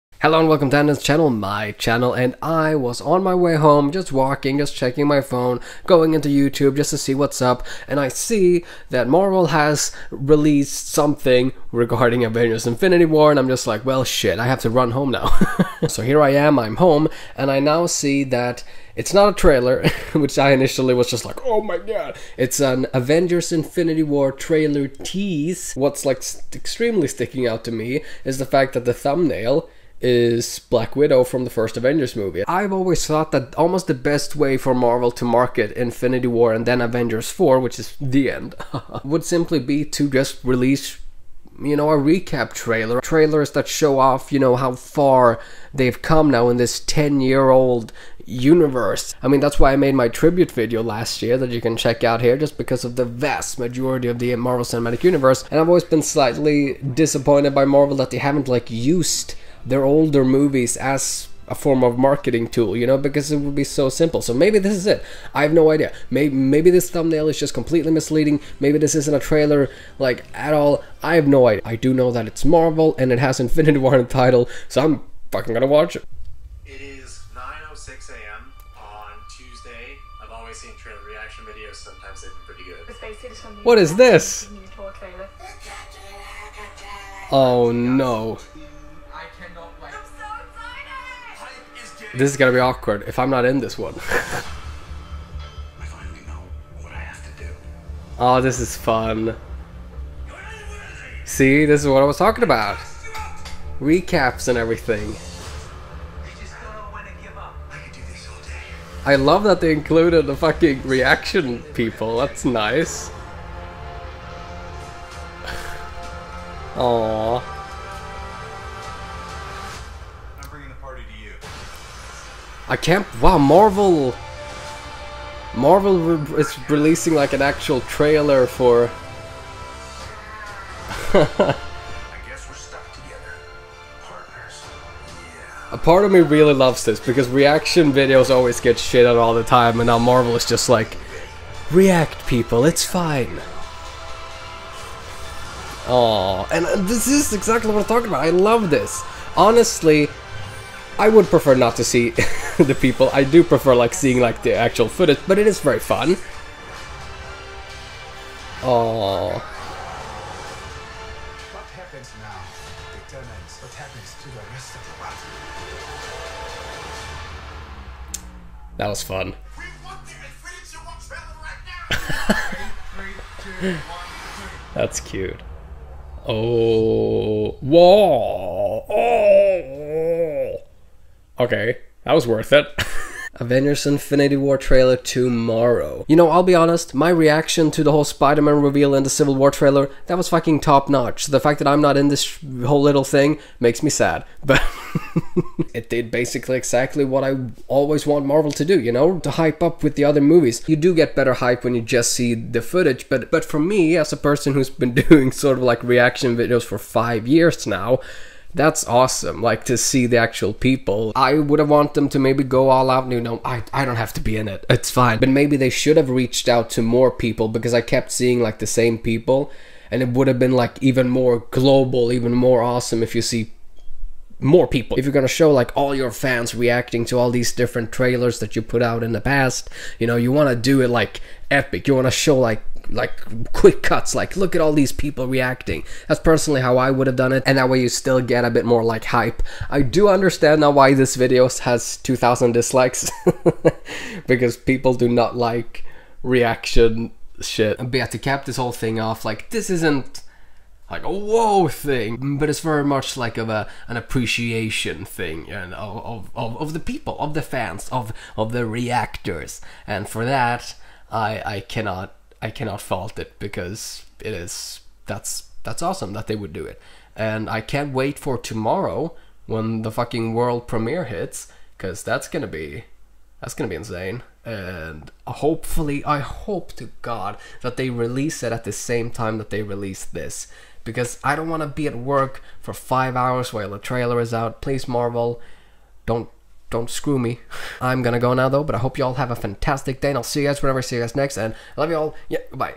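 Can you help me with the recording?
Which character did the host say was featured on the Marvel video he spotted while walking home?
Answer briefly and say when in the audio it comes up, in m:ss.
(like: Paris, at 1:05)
Black Widow, at 0:30.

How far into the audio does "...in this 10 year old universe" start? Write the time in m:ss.
0:46.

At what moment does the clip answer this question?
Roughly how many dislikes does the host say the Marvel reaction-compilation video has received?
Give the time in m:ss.
4:01.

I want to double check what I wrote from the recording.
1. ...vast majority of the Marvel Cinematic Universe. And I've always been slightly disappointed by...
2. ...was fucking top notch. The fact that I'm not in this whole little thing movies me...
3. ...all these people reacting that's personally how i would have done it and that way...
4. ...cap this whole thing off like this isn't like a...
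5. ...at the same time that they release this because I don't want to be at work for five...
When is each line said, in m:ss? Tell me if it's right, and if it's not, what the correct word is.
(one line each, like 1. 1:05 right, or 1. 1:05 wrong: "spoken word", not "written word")
1. 0:53 right
2. 3:10 wrong: "makes", not "movies"
3. 3:54 right
4. 4:08 right
5. 4:38 right.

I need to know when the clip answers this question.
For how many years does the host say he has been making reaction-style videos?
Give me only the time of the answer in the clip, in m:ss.
3:26.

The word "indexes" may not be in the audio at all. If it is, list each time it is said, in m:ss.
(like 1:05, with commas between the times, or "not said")
not said.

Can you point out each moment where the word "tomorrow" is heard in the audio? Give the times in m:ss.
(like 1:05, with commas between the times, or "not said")
3:04, 4:28.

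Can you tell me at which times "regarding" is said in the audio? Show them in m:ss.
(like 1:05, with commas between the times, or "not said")
0:11.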